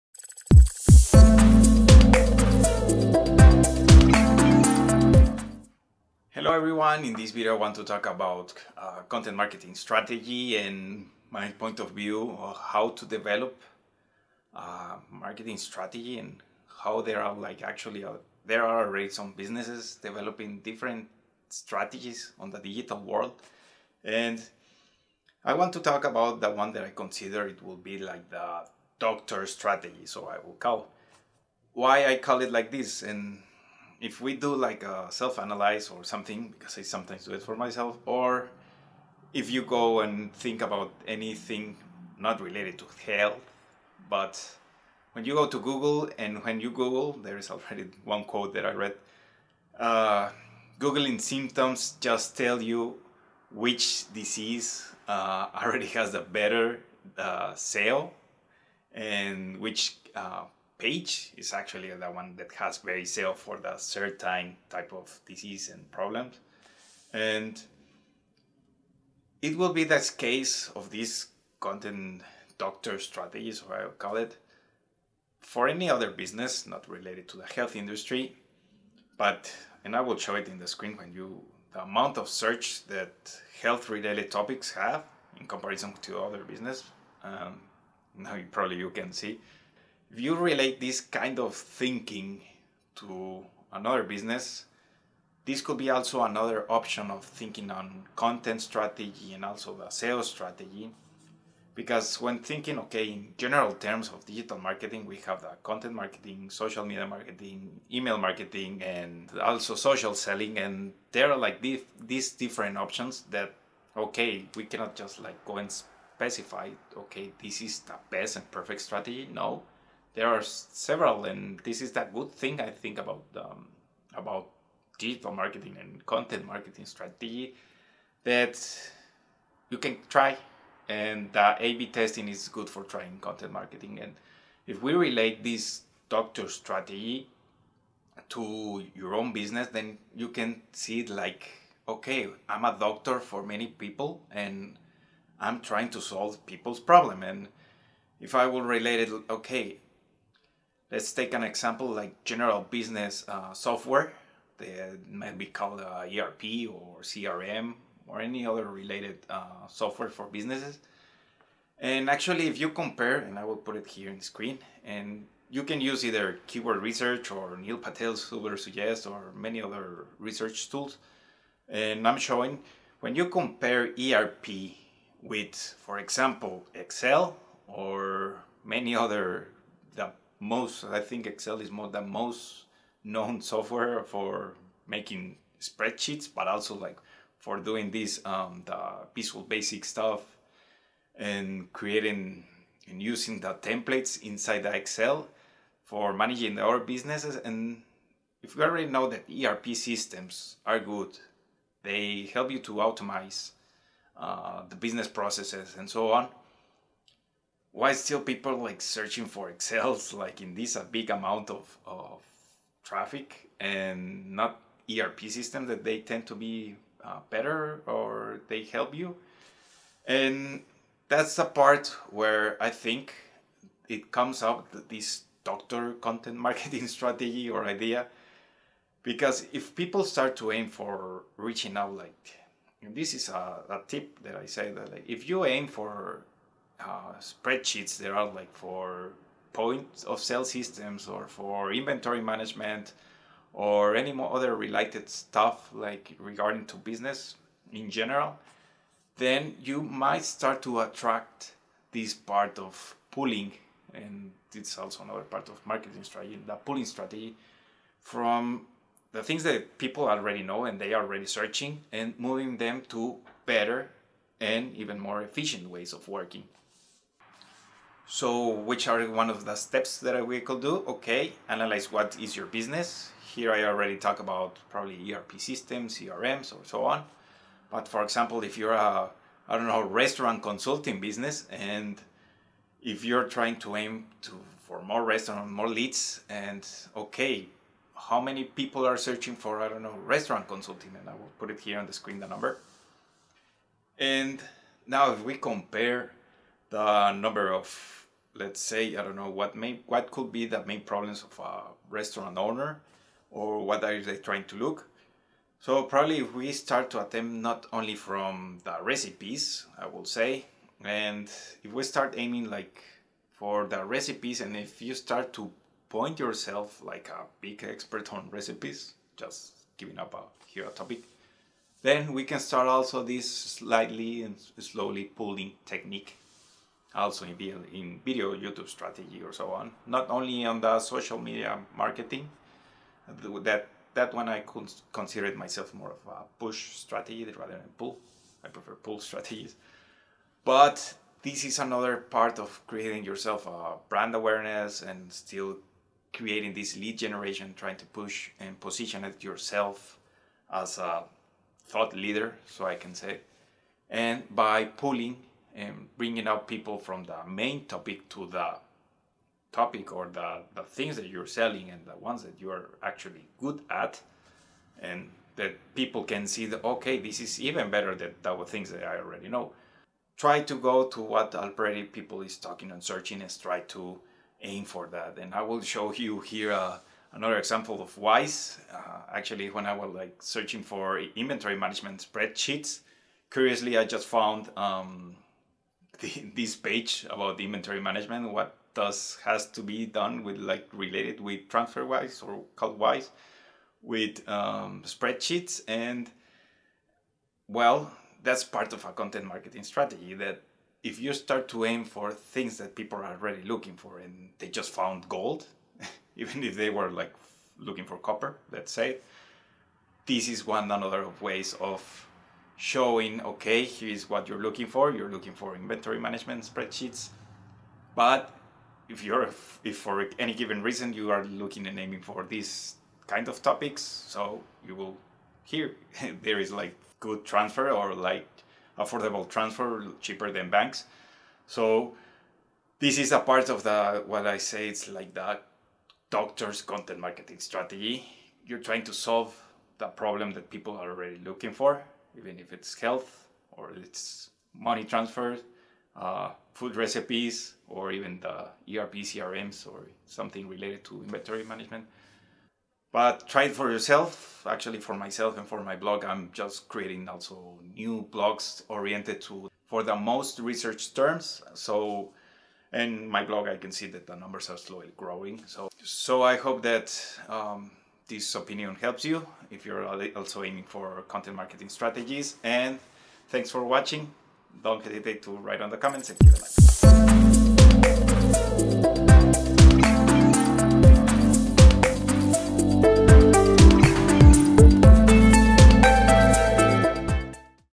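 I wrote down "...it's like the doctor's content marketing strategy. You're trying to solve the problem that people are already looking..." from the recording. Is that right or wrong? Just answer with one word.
right.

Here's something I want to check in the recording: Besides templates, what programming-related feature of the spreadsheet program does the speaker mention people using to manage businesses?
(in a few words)
visual basic.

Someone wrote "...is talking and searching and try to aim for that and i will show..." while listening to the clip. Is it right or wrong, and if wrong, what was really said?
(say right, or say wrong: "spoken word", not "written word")
right.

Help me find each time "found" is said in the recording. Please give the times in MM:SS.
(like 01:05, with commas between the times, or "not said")
06:24, 06:44.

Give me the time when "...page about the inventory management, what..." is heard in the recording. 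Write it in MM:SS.
06:26.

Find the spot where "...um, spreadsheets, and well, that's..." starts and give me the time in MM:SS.
06:34.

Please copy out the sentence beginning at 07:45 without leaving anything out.
So, so I hope that um, this opinion helps you if you're also aiming for content marketing strategies.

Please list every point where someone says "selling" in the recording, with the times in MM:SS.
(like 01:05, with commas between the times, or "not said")
01:50, 06:01.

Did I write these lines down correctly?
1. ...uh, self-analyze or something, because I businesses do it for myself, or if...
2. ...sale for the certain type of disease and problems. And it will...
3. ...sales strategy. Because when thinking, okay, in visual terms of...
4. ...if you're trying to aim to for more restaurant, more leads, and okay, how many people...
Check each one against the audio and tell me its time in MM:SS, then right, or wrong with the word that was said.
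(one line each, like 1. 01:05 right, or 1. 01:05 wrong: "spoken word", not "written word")
1. 00:34 wrong: "sometimes", not "businesses"
2. 01:03 right
3. 01:39 wrong: "general", not "visual"
4. 04:42 right.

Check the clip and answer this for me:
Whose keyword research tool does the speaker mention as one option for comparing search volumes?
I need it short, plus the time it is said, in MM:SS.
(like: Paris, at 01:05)
Neil Patel's Ubersuggest, at 02:47.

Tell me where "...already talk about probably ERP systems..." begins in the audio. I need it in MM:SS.
04:33.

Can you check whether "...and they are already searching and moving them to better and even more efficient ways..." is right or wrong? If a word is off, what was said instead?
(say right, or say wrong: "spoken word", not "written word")
right.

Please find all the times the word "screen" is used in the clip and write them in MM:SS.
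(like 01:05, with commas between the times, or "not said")
01:20, 02:44, 04:51.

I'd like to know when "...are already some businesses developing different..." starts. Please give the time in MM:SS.
00:18.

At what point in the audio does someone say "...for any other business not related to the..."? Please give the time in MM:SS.
01:15.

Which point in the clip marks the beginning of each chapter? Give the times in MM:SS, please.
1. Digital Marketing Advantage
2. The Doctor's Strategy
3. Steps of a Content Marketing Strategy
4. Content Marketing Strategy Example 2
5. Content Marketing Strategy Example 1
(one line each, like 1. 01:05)
1. 01:41
2. 00:27
3. 04:27
4. 06:15
5. 02:32.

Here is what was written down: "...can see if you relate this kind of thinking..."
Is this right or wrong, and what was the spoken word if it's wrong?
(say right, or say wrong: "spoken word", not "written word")
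right.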